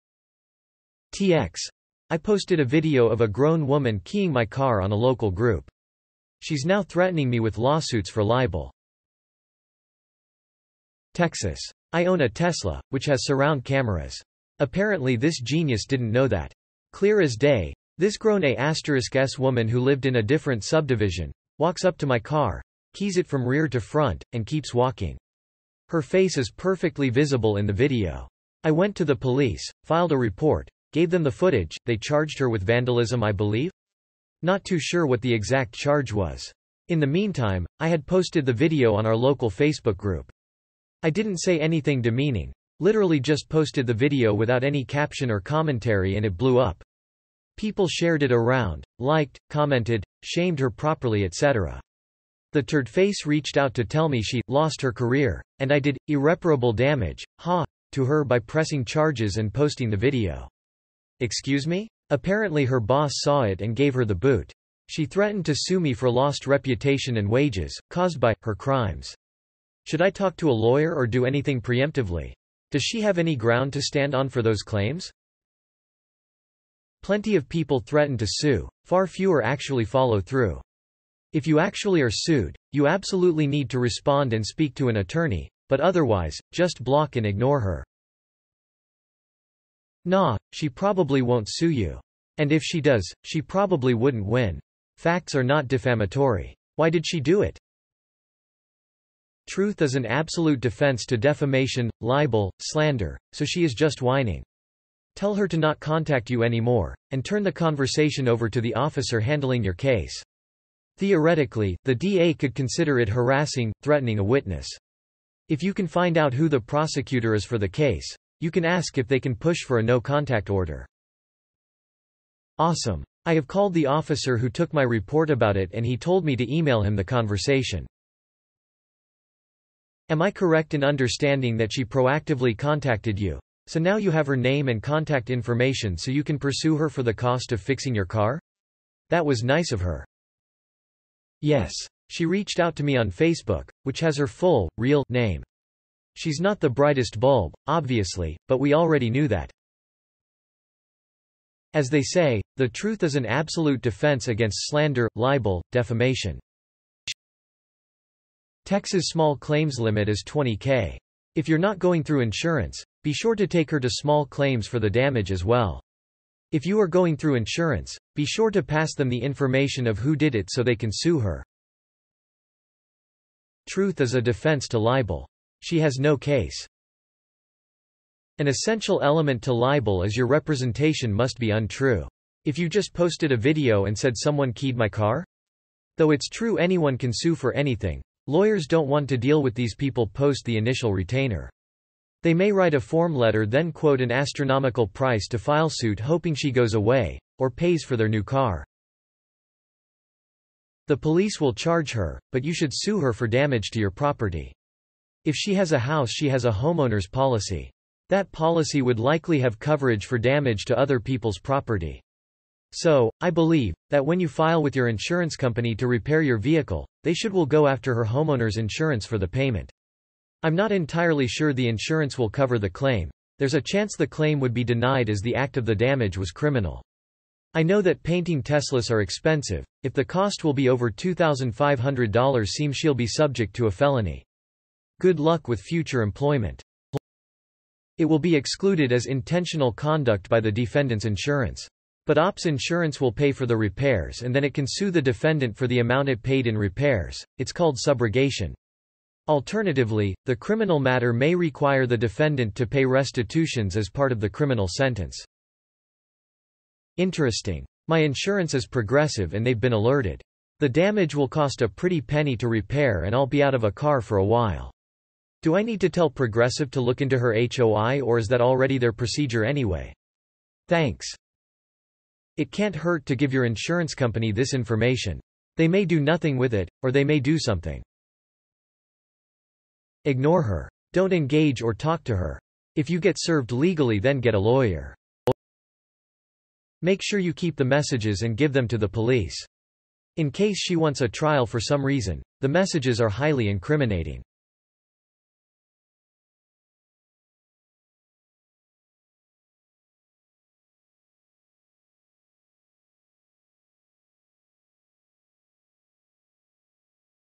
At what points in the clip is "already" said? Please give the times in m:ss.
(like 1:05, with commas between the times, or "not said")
2:28, 4:28.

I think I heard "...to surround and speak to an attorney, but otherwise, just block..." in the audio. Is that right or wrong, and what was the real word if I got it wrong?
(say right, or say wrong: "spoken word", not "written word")
wrong: "respond", not "surround".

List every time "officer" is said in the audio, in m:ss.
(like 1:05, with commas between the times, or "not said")
1:48, 2:03.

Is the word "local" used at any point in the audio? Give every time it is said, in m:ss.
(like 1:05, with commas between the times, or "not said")
0:04, 0:39.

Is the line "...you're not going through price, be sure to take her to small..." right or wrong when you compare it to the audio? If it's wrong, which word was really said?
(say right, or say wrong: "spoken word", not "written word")
wrong: "insurance", not "price".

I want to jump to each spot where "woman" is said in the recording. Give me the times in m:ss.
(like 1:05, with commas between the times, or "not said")
0:03, 0:19.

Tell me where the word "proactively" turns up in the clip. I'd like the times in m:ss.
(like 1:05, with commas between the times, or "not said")
2:11.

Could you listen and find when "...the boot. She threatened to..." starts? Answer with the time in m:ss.
1:04.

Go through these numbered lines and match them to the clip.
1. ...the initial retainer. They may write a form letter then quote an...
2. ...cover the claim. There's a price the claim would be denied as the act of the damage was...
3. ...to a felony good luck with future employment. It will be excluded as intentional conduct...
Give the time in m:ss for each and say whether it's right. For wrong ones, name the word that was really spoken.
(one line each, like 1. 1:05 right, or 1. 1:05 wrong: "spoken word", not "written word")
1. 3:10 right
2. 3:42 wrong: "chance", not "price"
3. 3:53 right.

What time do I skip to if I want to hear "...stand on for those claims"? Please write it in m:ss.
1:13.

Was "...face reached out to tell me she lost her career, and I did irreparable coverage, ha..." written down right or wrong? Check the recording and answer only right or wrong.
wrong.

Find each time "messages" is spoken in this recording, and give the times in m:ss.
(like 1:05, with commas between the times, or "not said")
4:47, 4:52.